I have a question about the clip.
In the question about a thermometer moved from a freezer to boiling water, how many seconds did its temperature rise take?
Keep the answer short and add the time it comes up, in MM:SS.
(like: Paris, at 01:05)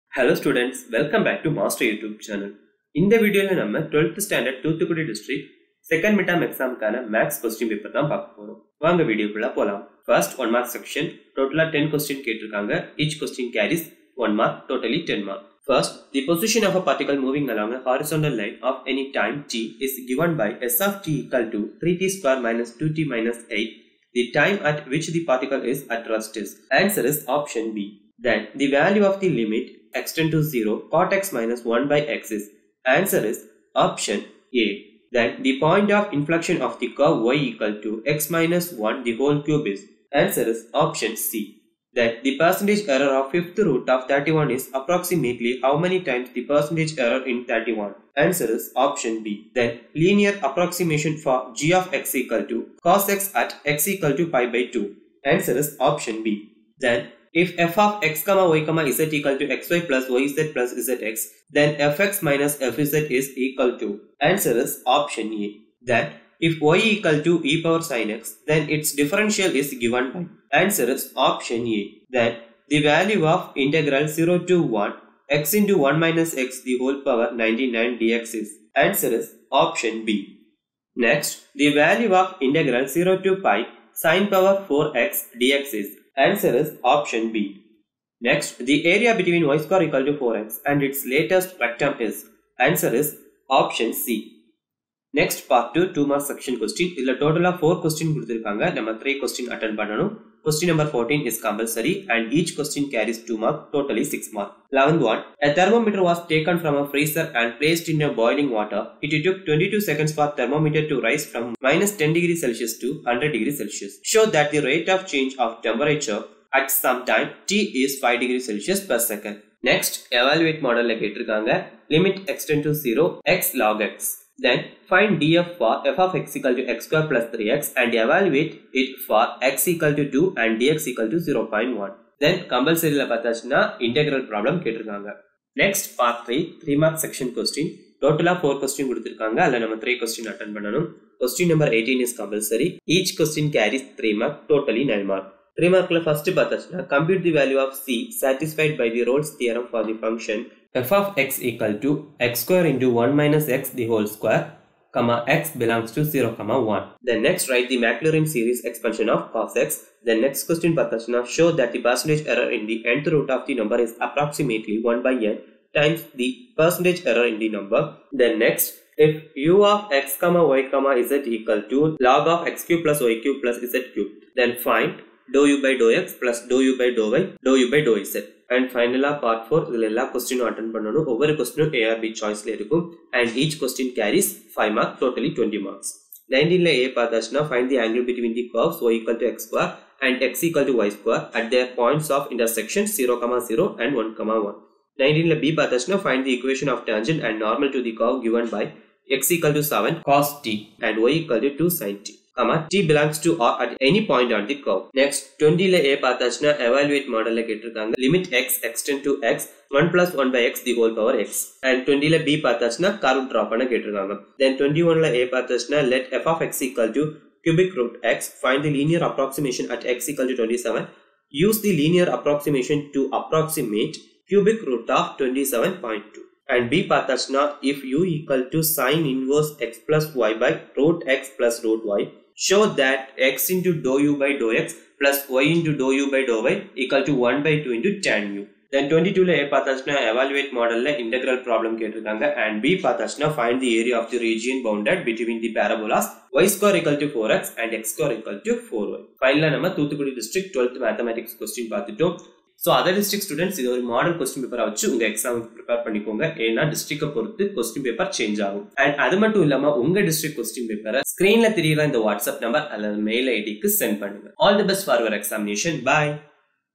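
22, at 01:49.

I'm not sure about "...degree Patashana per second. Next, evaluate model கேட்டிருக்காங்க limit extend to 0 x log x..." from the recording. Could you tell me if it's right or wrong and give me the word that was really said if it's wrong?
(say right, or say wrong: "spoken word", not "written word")
wrong: "Celsius", not "Patashana".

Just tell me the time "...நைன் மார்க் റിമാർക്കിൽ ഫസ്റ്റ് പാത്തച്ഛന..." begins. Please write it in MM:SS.
02:24.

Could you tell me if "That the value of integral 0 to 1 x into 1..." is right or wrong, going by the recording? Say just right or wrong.
right.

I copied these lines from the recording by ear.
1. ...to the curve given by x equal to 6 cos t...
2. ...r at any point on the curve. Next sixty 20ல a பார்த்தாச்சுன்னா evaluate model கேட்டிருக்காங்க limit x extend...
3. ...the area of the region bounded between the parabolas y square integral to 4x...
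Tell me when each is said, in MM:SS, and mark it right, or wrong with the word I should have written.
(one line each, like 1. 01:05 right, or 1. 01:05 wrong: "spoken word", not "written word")
1. 03:17 wrong: "7", not "6"
2. 03:23 wrong: "twenty", not "sixty"
3. 04:03 wrong: "equal", not "integral".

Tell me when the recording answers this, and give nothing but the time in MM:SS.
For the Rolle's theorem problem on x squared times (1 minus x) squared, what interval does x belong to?
02:36.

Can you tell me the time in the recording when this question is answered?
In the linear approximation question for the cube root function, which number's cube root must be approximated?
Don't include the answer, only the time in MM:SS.
03:45.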